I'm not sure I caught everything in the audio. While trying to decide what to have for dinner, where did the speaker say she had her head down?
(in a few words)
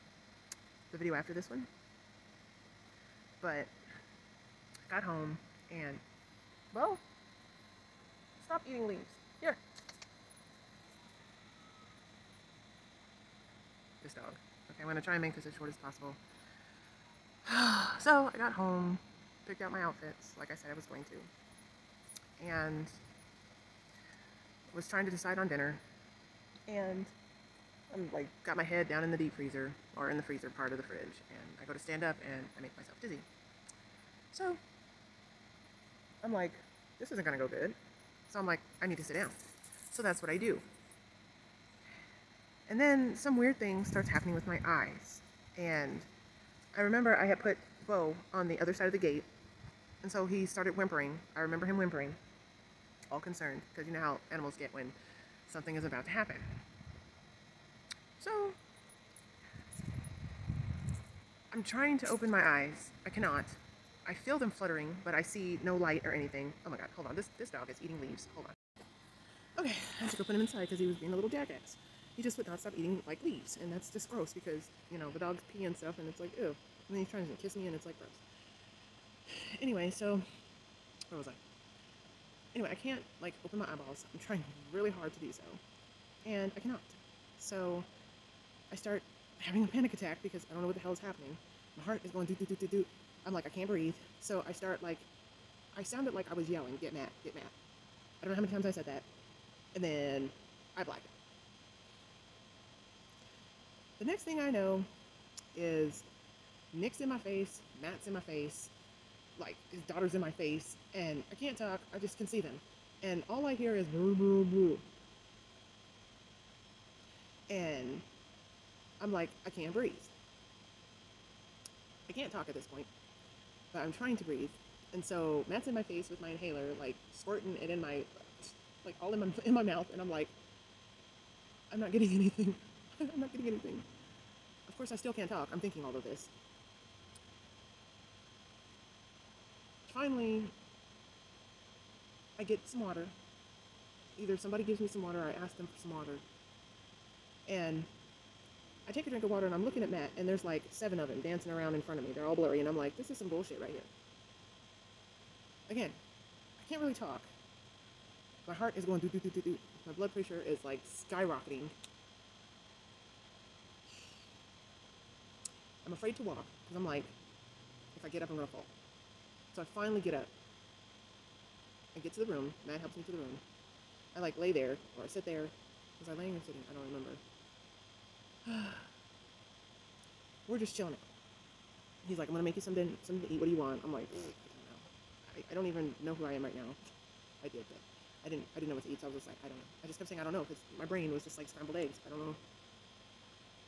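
deep freezer.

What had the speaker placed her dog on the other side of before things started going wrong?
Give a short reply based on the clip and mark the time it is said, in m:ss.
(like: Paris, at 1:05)
the gate, at 0:48.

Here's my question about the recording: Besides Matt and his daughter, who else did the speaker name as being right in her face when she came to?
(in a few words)
Nick.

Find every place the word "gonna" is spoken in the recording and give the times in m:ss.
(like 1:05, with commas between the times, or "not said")
2:48, 3:02.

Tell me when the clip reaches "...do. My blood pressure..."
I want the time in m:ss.
2:39.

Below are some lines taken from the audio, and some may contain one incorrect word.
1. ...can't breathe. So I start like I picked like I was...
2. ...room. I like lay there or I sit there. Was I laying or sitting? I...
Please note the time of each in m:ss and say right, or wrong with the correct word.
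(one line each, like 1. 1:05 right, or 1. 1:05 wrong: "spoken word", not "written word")
1. 1:33 wrong: "sounded", not "picked"
2. 2:53 right.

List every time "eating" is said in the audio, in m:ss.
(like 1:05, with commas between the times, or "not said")
0:08, 1:07, 1:12.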